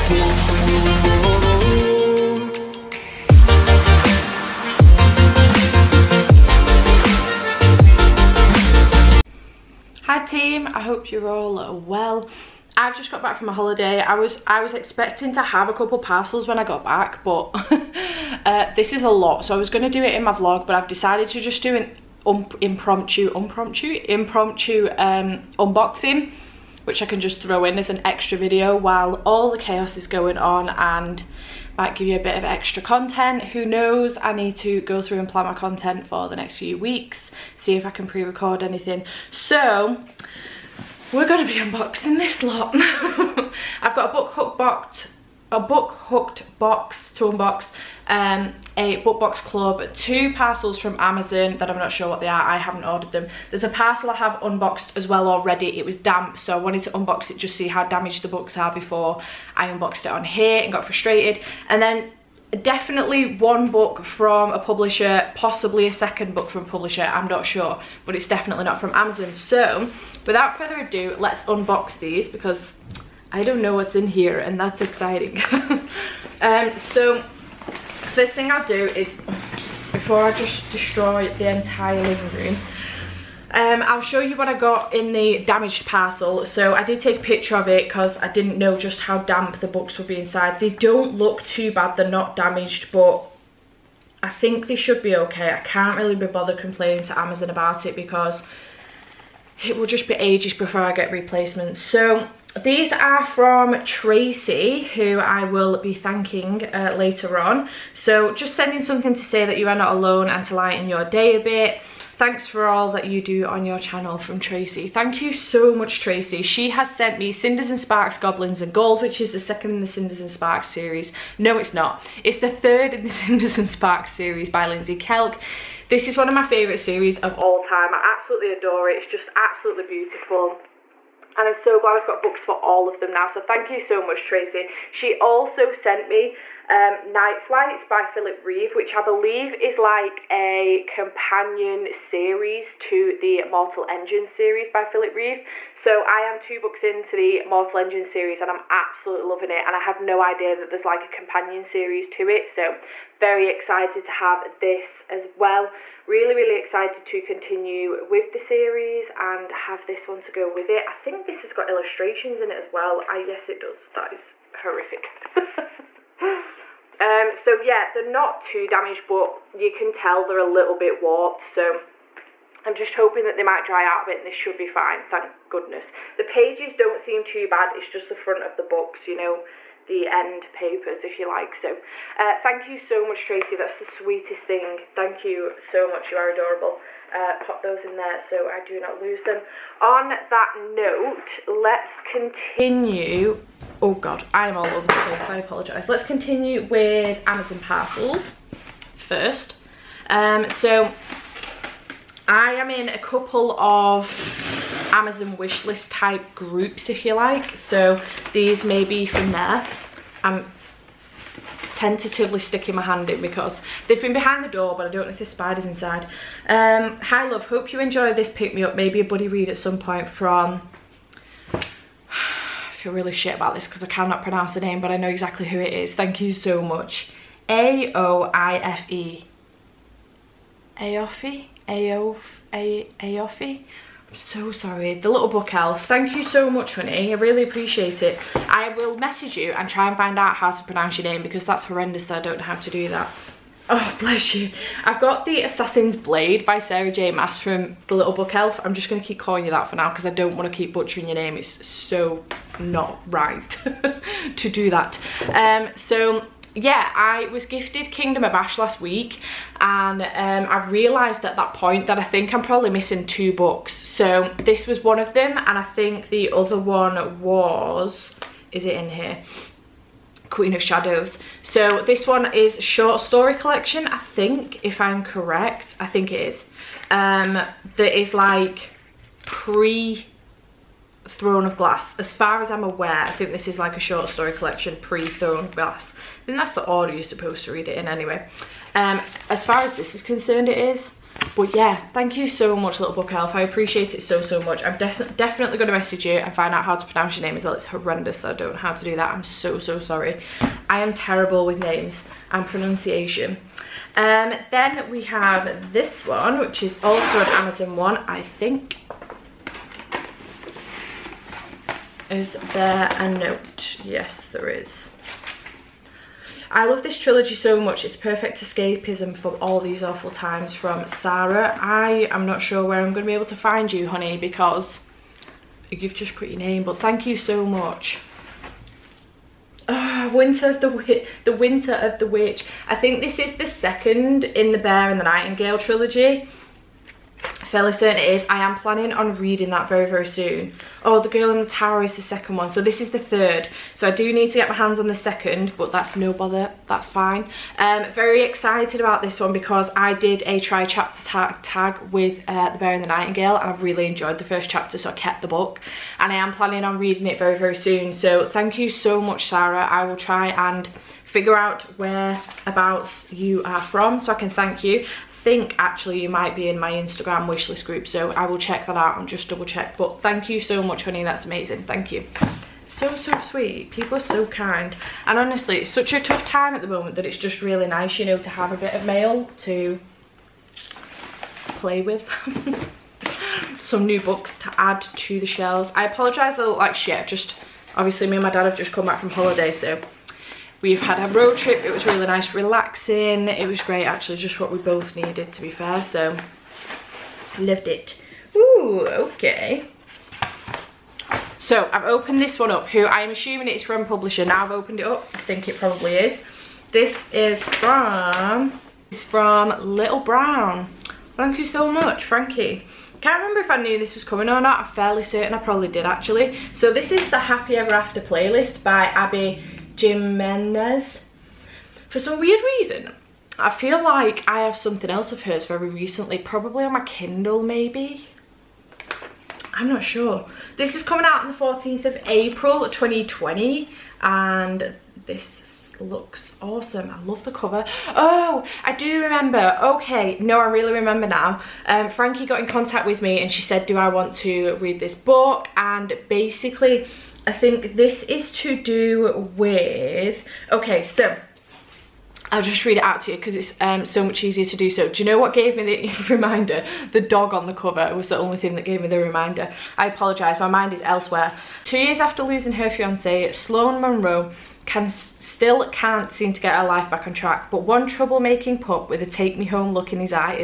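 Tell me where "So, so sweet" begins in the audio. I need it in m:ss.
6:12.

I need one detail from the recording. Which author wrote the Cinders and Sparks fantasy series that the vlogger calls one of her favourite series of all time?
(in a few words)
Lindsay Kelk.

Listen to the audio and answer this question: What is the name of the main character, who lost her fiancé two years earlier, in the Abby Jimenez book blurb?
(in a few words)
Sloan Monroe.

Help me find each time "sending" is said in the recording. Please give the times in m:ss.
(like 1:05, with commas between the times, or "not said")
1:48.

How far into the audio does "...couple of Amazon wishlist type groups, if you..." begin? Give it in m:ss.
3:22.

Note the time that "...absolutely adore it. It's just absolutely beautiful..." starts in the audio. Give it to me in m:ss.
2:07.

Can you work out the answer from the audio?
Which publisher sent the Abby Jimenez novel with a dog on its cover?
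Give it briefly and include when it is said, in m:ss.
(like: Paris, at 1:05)
Little Brown, at 6:49.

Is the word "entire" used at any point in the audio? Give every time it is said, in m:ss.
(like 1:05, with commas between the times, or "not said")
1:21.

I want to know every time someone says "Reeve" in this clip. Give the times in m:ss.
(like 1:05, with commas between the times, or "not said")
2:18, 2:25.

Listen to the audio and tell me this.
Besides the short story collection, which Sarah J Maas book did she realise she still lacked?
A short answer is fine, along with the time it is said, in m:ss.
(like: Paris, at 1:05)
Queen of Shadows, at 4:30.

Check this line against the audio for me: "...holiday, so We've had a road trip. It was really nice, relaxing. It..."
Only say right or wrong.
right.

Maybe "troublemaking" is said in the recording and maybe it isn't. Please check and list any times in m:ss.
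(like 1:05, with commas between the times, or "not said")
7:47.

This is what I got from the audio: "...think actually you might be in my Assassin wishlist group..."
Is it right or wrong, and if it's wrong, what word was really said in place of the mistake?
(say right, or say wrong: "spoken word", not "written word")
wrong: "Instagram", not "Assassin".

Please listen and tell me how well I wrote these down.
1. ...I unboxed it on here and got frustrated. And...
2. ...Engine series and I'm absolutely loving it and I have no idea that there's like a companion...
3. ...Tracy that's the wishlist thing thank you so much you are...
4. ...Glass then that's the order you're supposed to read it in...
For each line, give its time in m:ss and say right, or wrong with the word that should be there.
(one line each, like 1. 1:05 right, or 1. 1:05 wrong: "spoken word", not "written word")
1. 0:59 right
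2. 2:27 right
3. 3:03 wrong: "sweetest", not "wishlist"
4. 4:45 right.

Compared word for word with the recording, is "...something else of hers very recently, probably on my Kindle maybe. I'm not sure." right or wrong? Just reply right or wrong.
right.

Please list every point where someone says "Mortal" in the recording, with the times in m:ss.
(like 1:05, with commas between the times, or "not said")
2:23, 2:27.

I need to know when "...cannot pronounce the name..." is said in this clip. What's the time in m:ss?
3:43.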